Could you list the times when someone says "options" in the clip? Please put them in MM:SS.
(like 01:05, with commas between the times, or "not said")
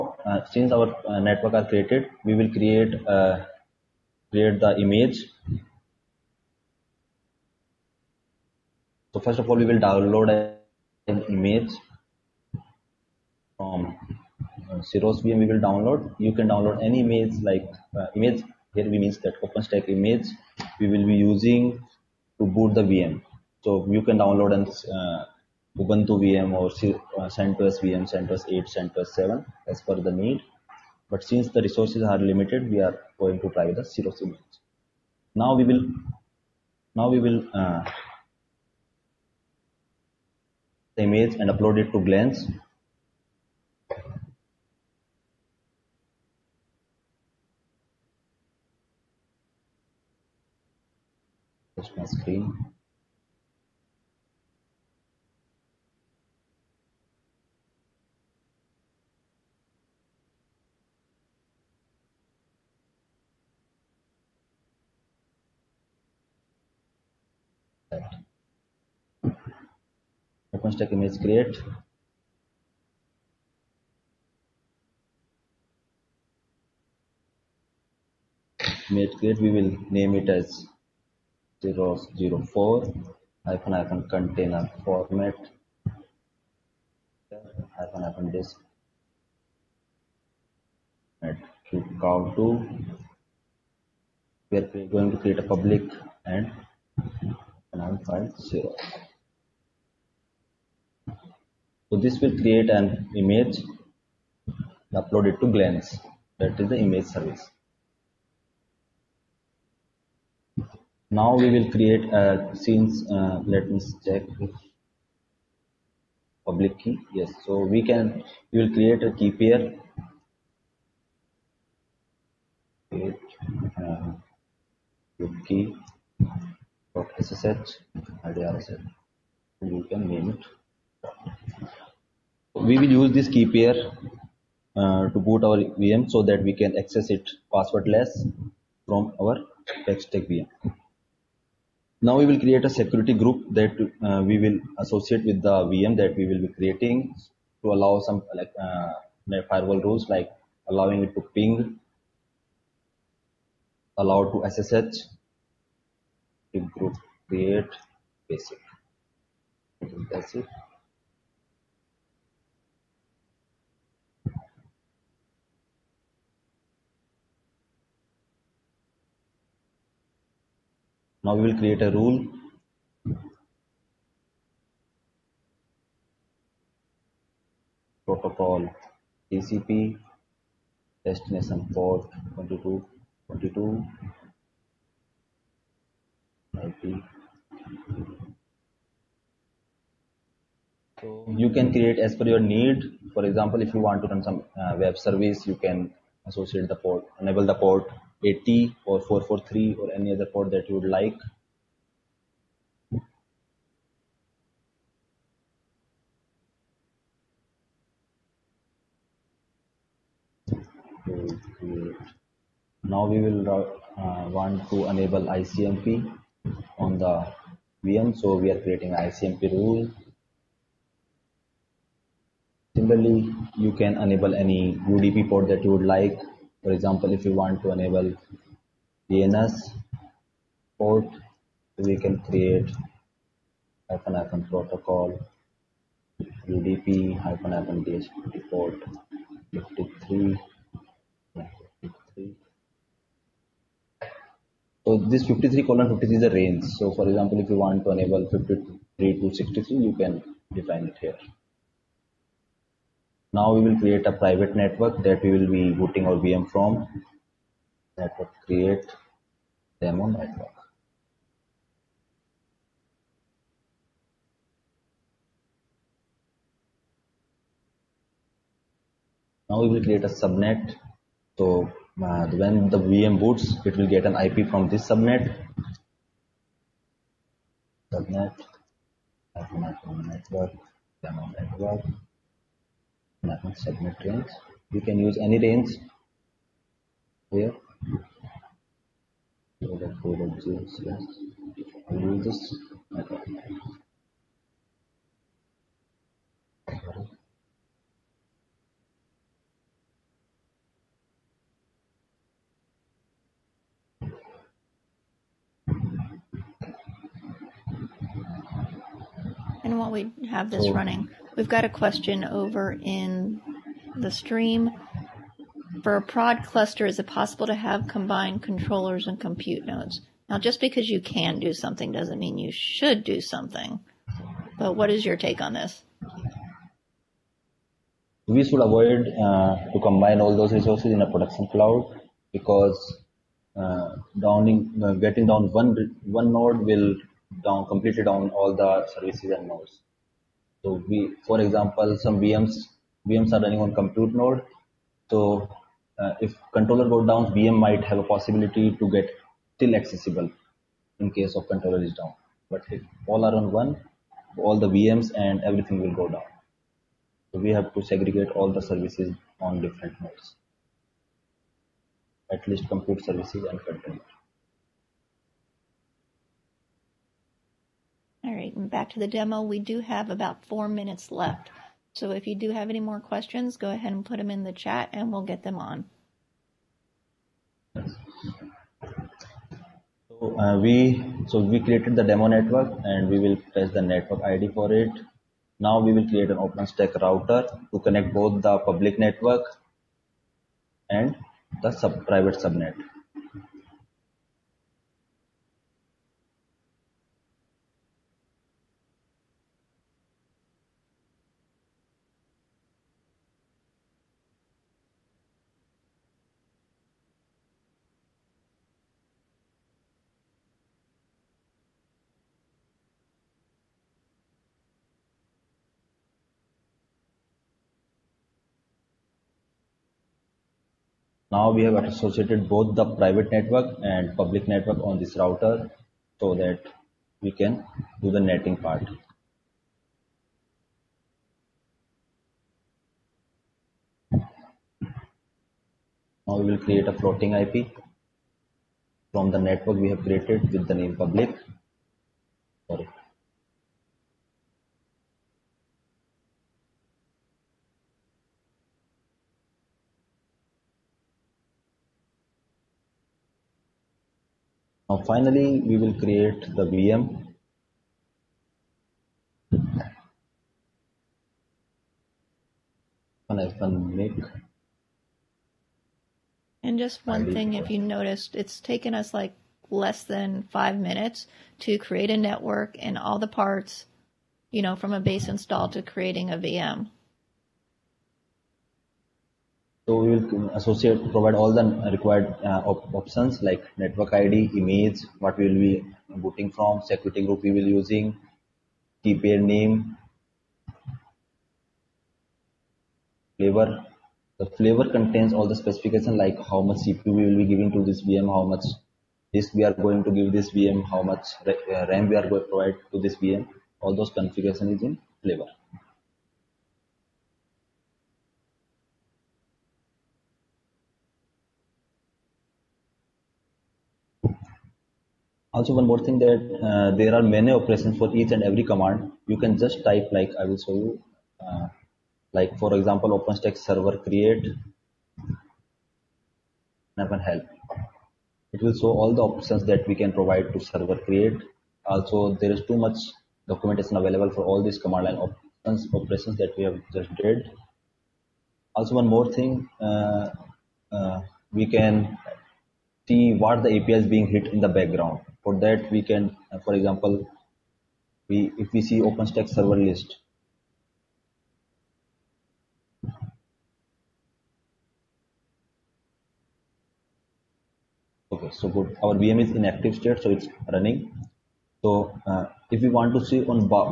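08:02, 08:49, 08:55.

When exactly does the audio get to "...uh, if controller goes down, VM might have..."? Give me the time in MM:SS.
05:46.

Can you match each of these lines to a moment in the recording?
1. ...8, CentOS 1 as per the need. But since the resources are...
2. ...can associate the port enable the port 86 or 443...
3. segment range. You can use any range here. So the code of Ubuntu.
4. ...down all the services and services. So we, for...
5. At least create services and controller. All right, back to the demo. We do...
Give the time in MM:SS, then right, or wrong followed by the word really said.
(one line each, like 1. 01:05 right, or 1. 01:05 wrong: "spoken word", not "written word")
1. 00:28 wrong: "7", not "1"
2. 03:15 wrong: "80", not "86"
3. 04:43 wrong: "JSS", not "Ubuntu"
4. 05:38 wrong: "nodes", not "services"
5. 06:02 wrong: "compute", not "create".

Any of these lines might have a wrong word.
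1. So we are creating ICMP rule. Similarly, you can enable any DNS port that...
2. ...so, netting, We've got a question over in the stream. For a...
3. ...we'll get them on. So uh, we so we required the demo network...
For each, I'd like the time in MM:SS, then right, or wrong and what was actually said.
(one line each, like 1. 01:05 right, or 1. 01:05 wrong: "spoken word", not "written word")
1. 03:38 wrong: "UDP", not "DNS"
2. 05:10 wrong: "running", not "netting"
3. 06:15 wrong: "created", not "required".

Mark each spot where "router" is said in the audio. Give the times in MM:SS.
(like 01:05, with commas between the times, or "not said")
06:27, 07:05.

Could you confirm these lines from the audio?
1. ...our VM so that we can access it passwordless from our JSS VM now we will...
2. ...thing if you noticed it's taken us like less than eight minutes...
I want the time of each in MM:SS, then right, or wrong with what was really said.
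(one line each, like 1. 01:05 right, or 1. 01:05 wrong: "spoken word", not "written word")
1. 02:15 wrong: "Packstack", not "JSS"
2. 07:47 wrong: "five", not "eight".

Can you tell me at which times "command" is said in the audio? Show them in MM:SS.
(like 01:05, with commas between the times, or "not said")
08:38, 08:54.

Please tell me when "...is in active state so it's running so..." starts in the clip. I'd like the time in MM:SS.
09:19.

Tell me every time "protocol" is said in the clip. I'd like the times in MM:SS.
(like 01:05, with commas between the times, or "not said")
02:58, 03:54.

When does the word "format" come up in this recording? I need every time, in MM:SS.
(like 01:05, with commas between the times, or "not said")
01:24, 01:31.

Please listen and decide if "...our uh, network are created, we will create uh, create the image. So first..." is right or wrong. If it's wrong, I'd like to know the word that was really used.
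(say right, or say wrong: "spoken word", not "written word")
right.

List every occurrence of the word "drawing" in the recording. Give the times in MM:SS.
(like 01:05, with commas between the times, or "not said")
not said.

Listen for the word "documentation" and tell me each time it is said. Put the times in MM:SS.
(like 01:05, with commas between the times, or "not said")
08:53.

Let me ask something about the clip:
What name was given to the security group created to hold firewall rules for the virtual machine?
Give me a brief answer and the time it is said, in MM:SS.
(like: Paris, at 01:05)
basic, at 02:38.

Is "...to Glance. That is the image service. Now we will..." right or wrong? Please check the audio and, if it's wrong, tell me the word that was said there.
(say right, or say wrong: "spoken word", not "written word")
right.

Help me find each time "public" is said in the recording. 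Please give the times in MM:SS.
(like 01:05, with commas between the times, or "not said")
01:35, 01:56, 06:28, 07:04, 07:20.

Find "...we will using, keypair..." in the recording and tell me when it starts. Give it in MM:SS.
08:07.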